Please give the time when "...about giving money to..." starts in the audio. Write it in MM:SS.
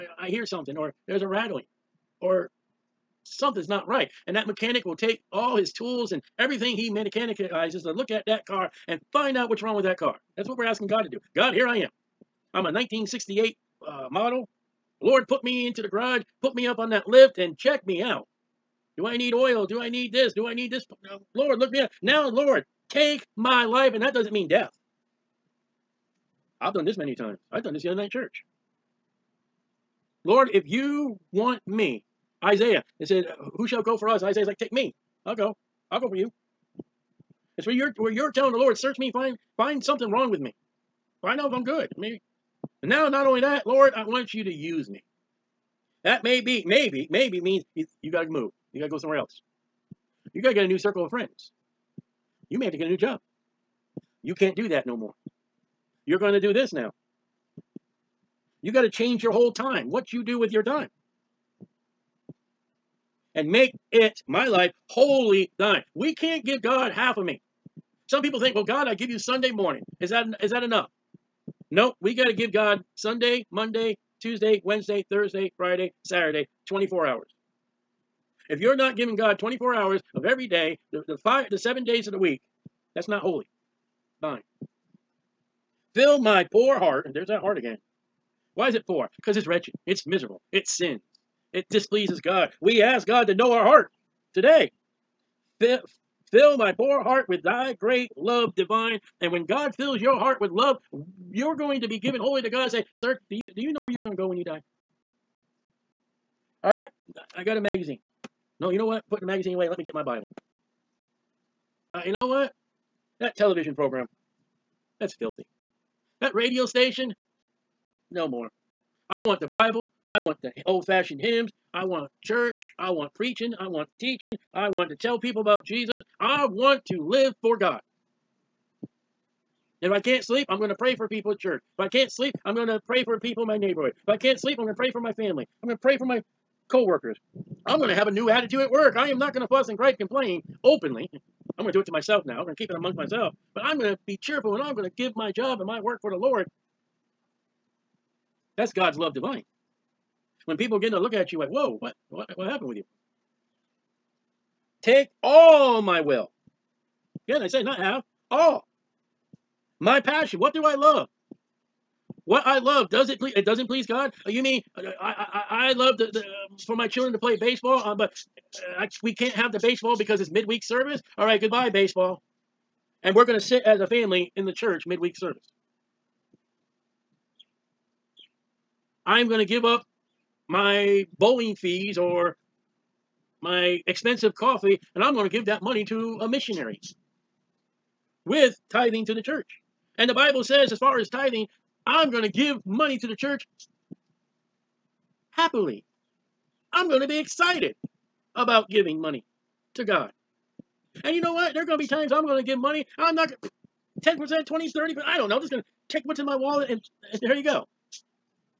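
03:18.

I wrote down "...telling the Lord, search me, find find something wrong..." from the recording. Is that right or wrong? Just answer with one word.
right.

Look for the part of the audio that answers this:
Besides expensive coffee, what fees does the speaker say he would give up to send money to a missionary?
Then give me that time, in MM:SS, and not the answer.
03:01.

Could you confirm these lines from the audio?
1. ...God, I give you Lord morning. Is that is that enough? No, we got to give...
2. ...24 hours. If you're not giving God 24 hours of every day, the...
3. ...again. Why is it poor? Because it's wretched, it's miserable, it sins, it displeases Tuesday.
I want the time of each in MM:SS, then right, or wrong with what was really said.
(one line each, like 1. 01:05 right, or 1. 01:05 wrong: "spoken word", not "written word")
1. 01:08 wrong: "Sunday", not "Lord"
2. 01:16 right
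3. 01:27 wrong: "God", not "Tuesday".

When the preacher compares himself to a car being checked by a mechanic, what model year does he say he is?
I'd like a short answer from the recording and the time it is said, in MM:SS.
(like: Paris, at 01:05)
1968, at 00:12.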